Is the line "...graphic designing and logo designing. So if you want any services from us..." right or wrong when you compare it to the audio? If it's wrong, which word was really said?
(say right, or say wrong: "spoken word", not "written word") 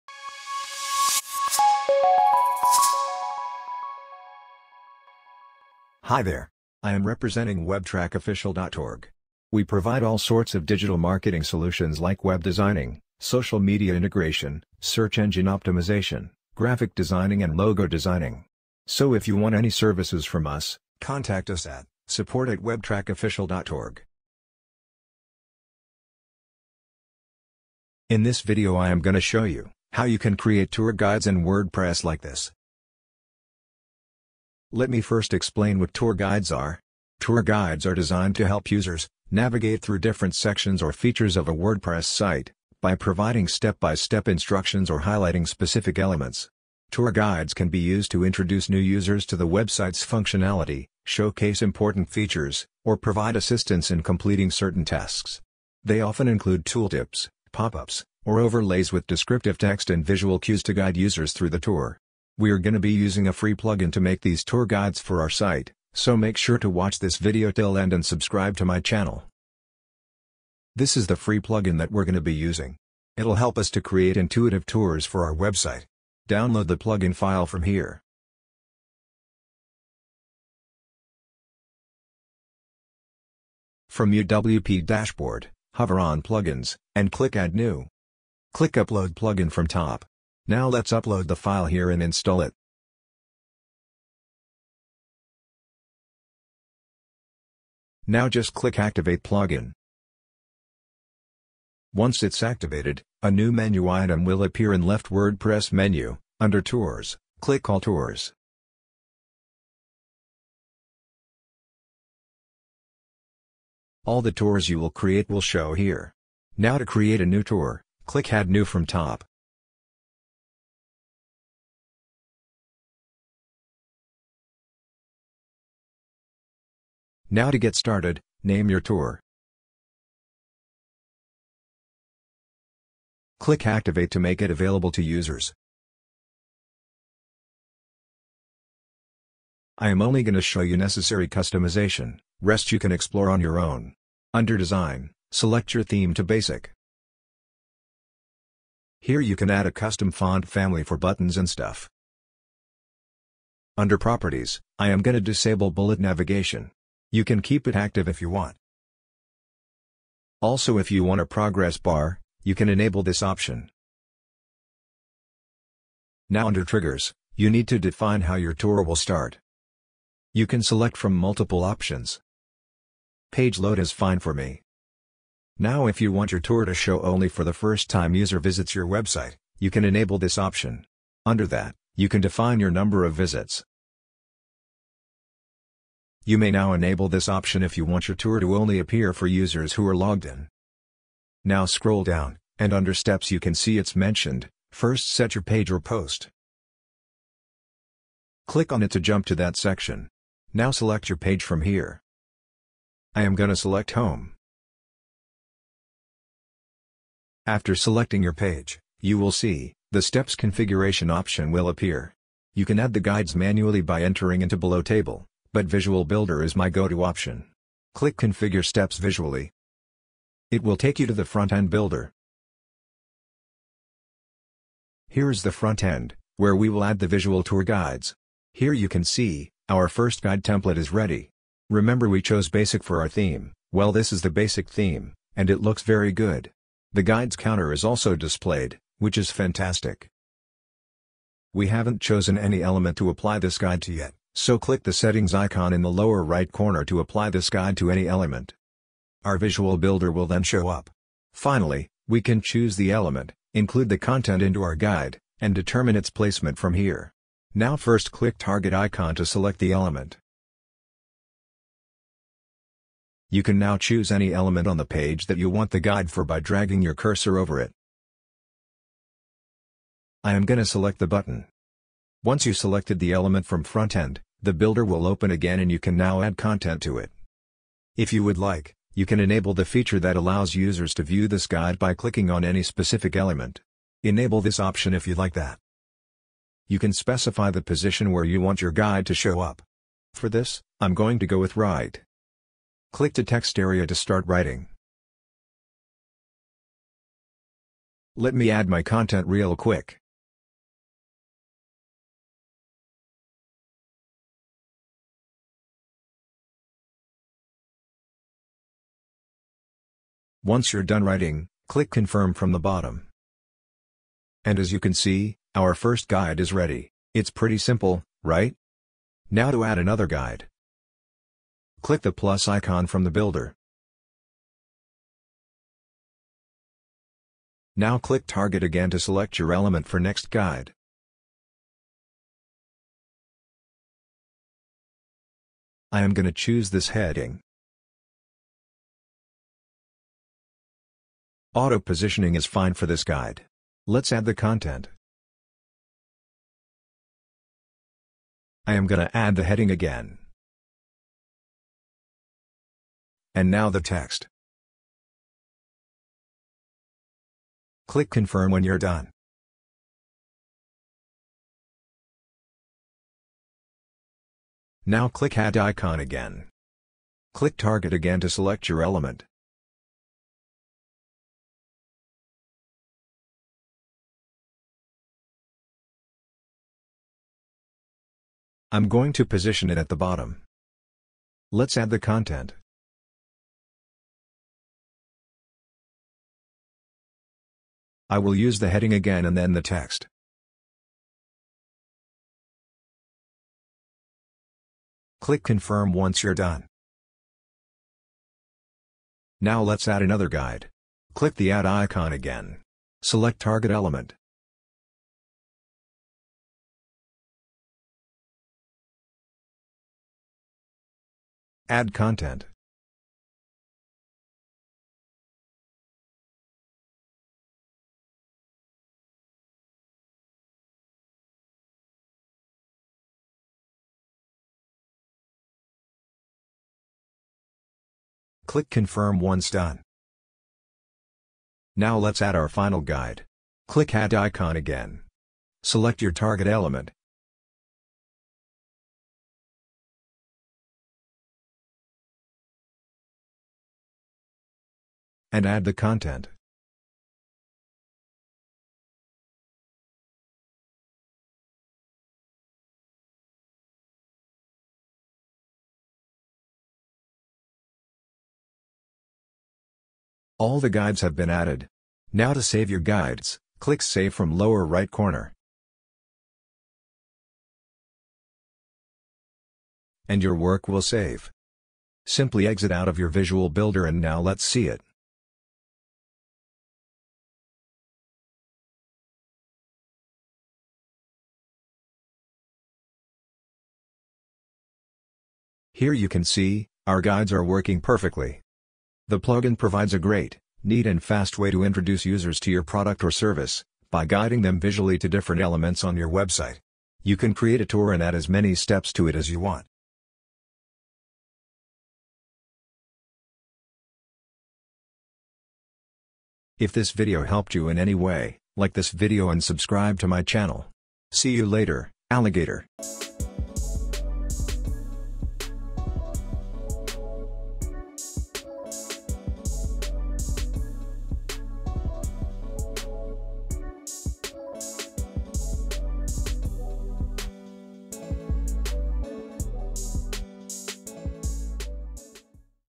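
right.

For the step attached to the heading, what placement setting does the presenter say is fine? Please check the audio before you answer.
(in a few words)
Auto positioning.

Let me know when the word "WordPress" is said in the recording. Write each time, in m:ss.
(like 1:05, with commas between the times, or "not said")
0:31, 0:41, 1:45.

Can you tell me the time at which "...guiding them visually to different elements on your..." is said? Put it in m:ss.
8:14.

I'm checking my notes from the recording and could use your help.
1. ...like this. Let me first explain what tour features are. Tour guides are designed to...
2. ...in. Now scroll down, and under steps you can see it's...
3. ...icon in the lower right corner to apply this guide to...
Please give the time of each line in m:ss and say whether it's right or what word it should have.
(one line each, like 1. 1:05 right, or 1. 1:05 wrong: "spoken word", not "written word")
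1. 0:32 wrong: "guides", not "features"
2. 3:10 right
3. 4:05 right.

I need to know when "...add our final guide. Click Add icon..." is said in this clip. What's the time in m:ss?
7:12.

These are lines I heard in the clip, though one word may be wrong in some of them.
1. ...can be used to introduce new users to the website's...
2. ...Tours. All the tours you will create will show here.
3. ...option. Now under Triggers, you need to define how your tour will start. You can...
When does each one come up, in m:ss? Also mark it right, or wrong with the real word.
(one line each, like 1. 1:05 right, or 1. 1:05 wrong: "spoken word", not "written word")
1. 0:47 right
2. 1:47 right
3. 2:43 right.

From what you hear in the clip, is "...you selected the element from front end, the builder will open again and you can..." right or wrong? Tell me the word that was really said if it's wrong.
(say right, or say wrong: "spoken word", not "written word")
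right.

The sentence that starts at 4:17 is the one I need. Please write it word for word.
Now first click target icon to select the element.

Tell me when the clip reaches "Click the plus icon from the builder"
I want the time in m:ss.
5:21.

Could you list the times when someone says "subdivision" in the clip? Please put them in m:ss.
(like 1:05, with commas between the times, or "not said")
not said.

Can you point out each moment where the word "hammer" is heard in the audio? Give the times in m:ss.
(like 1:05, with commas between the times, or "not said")
not said.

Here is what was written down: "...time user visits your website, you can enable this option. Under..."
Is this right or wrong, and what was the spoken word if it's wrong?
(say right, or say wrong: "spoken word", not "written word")
right.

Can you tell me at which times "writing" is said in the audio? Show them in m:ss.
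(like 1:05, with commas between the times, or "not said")
4:54, 5:11.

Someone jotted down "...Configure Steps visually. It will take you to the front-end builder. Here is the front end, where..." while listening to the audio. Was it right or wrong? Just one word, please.
right.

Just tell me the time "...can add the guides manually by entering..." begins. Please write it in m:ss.
3:32.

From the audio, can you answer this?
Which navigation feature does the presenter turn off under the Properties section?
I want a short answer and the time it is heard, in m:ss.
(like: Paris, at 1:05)
bullet navigation, at 2:35.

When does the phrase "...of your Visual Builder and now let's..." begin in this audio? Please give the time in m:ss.
7:52.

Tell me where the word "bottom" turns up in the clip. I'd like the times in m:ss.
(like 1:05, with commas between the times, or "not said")
5:12, 6:19.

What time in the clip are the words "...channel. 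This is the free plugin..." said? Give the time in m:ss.
1:08.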